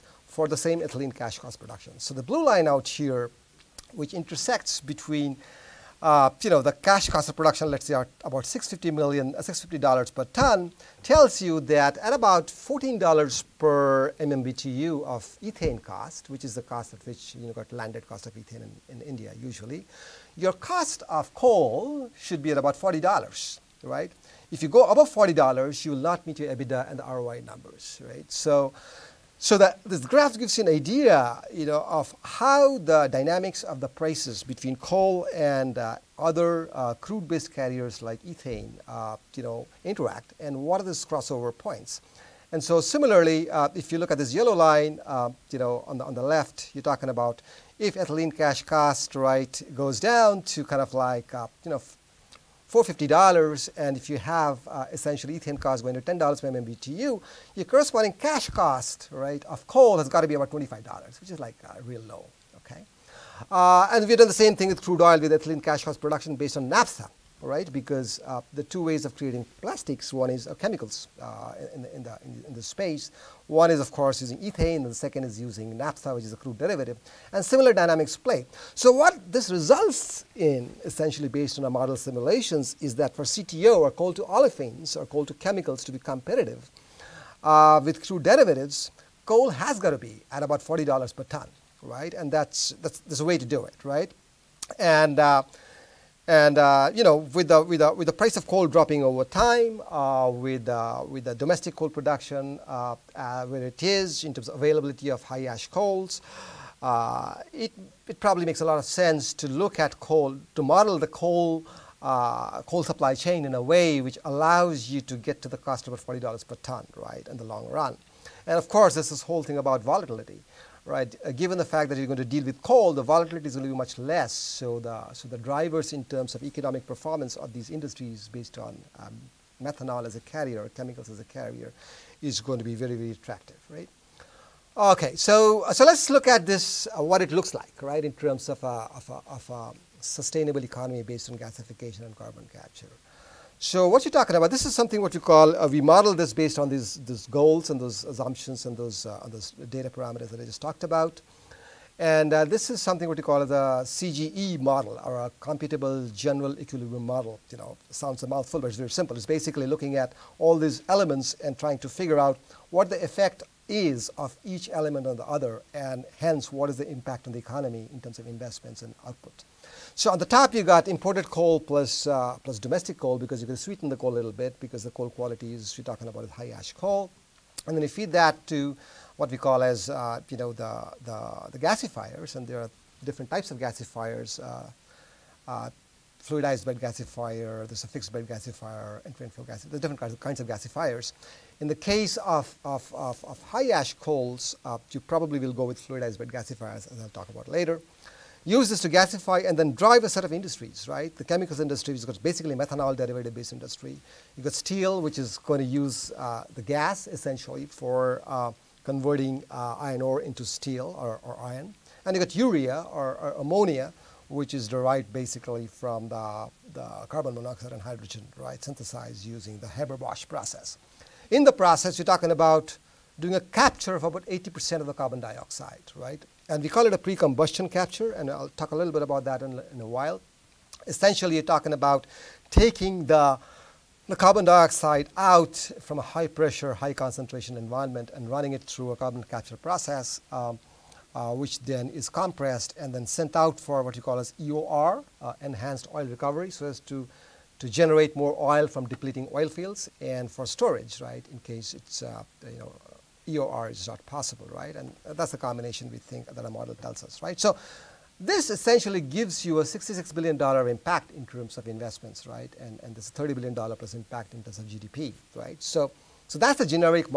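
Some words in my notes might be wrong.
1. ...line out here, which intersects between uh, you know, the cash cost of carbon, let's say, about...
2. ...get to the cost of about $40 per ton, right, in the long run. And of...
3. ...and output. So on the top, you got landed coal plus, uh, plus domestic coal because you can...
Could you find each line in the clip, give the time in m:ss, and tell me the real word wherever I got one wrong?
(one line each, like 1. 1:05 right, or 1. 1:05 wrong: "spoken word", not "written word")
1. 0:02 wrong: "production", not "carbon"
2. 1:55 right
3. 2:48 wrong: "imported", not "landed".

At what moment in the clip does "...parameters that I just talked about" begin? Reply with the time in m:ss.
2:29.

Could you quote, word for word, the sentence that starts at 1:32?
And that's, that's, there's a way to do it, right?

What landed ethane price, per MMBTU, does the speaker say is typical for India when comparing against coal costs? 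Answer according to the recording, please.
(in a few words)
$14 per MMBTU.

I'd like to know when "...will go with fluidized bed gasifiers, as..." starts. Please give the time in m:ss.
3:15.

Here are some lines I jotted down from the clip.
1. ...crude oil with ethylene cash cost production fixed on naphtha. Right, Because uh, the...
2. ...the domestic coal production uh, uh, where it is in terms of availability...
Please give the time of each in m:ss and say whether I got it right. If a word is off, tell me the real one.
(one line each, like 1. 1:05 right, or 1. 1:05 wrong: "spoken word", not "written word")
1. 1:04 wrong: "based", not "fixed"
2. 1:41 right.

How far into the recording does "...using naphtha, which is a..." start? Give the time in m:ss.
1:15.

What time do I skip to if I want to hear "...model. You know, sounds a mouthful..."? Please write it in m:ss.
2:37.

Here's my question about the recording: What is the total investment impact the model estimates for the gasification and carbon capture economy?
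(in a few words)
$66 billion.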